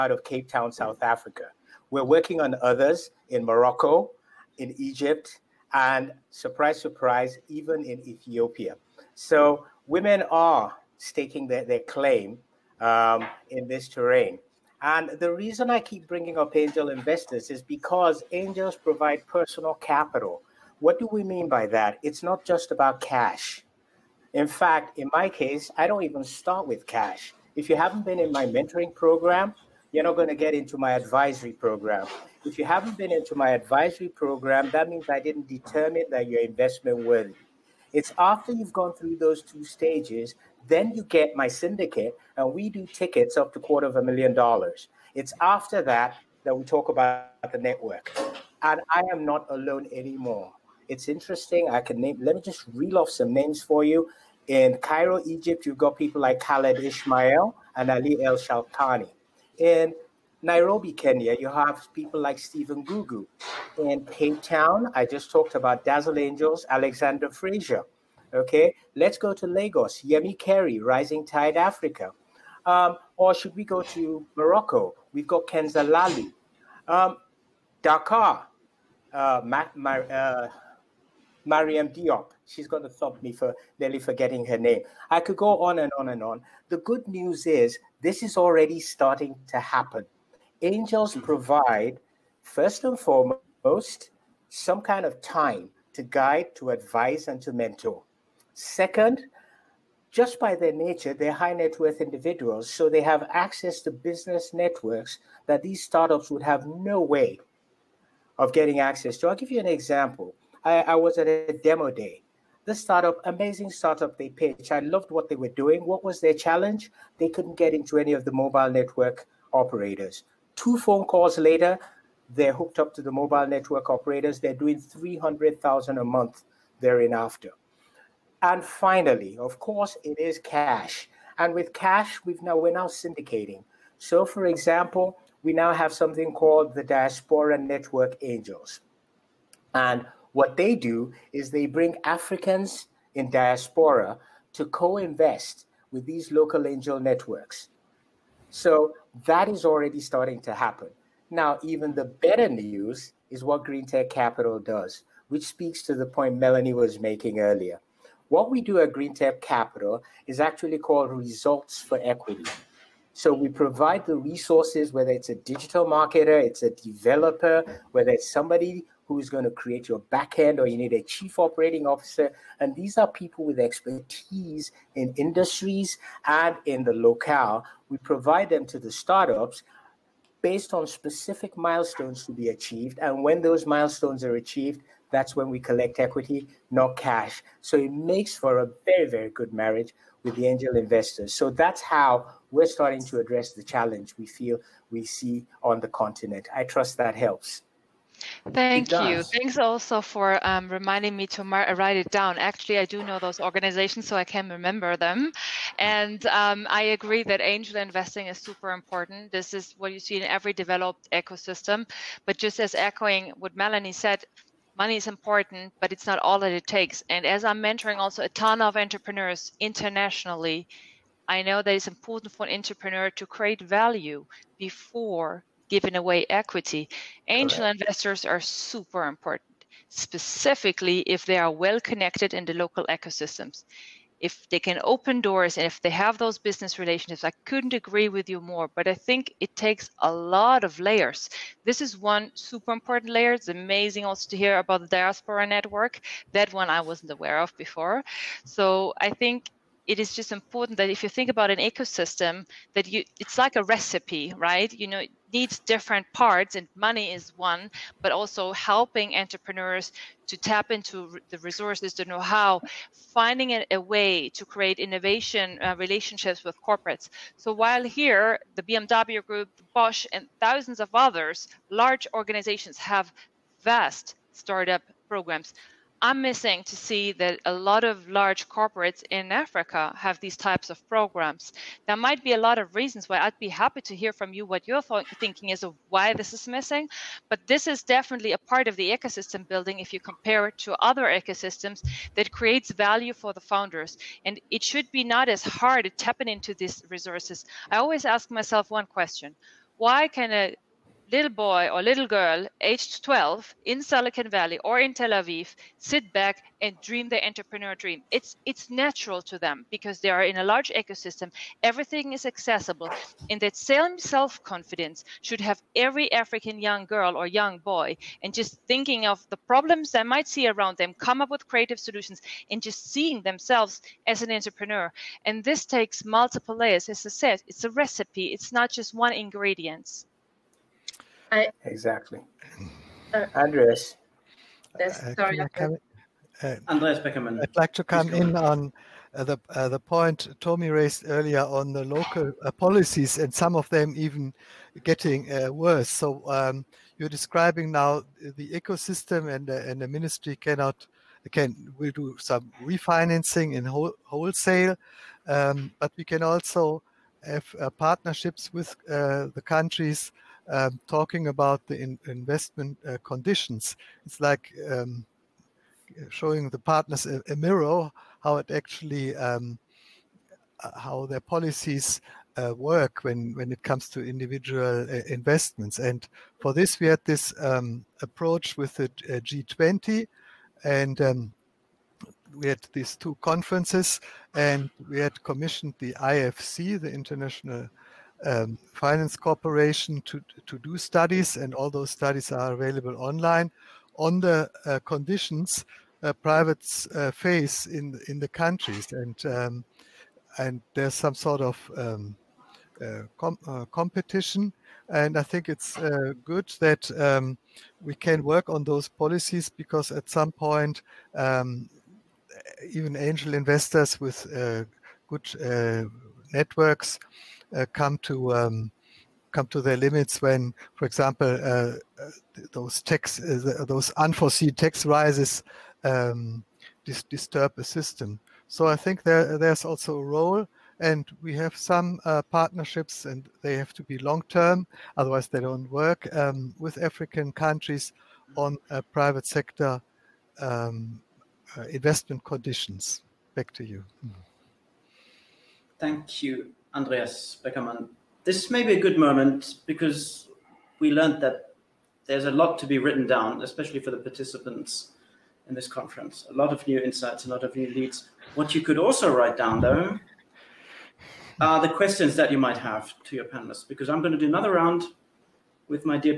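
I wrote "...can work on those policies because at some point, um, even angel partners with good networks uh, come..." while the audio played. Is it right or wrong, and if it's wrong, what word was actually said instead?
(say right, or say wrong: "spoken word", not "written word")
wrong: "investors", not "partners".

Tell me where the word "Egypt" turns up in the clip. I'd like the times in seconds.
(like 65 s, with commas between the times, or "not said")
4 s, 55 s.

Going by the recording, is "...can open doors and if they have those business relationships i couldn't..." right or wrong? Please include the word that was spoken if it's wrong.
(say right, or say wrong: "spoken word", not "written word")
right.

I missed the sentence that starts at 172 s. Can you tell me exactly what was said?
And these are people with expertise in industries and in the locale.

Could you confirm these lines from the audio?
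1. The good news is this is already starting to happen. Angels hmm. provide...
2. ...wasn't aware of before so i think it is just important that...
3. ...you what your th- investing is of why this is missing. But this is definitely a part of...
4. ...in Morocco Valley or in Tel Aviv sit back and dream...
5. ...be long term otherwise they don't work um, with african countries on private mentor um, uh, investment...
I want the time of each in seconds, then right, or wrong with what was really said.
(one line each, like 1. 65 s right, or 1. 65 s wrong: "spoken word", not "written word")
1. 86 s right
2. 246 s right
3. 284 s wrong: "thinking", not "investing"
4. 303 s wrong: "Silicon", not "Morocco"
5. 433 s wrong: "sector", not "mentor".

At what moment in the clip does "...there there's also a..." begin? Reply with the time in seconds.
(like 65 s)
429 s.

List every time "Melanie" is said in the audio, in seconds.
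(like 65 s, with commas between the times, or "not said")
156 s, 213 s.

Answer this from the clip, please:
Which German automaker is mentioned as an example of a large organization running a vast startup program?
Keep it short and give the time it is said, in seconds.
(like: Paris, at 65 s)
BMW Group, at 268 s.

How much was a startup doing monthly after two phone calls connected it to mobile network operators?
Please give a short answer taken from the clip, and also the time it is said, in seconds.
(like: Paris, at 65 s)
300,000, at 124 s.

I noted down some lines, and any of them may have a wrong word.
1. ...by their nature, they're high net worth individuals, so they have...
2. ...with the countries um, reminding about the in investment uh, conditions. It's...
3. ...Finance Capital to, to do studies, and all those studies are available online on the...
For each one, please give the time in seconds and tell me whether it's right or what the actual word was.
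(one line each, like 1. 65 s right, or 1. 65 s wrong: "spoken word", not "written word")
1. 100 s right
2. 358 s wrong: "talking", not "reminding"
3. 388 s wrong: "Corporation", not "Capital".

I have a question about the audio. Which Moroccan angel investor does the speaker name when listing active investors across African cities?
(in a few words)
Kenza Lahlou.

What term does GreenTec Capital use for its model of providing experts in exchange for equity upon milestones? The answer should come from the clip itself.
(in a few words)
results for equity.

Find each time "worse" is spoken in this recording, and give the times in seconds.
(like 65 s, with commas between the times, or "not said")
345 s.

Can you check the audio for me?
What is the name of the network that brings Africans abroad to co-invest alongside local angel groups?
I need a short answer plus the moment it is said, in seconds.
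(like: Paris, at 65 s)
Diaspora Network Angels, at 136 s.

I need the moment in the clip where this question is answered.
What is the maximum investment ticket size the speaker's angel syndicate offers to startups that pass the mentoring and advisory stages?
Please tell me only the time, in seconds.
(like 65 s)
43 s.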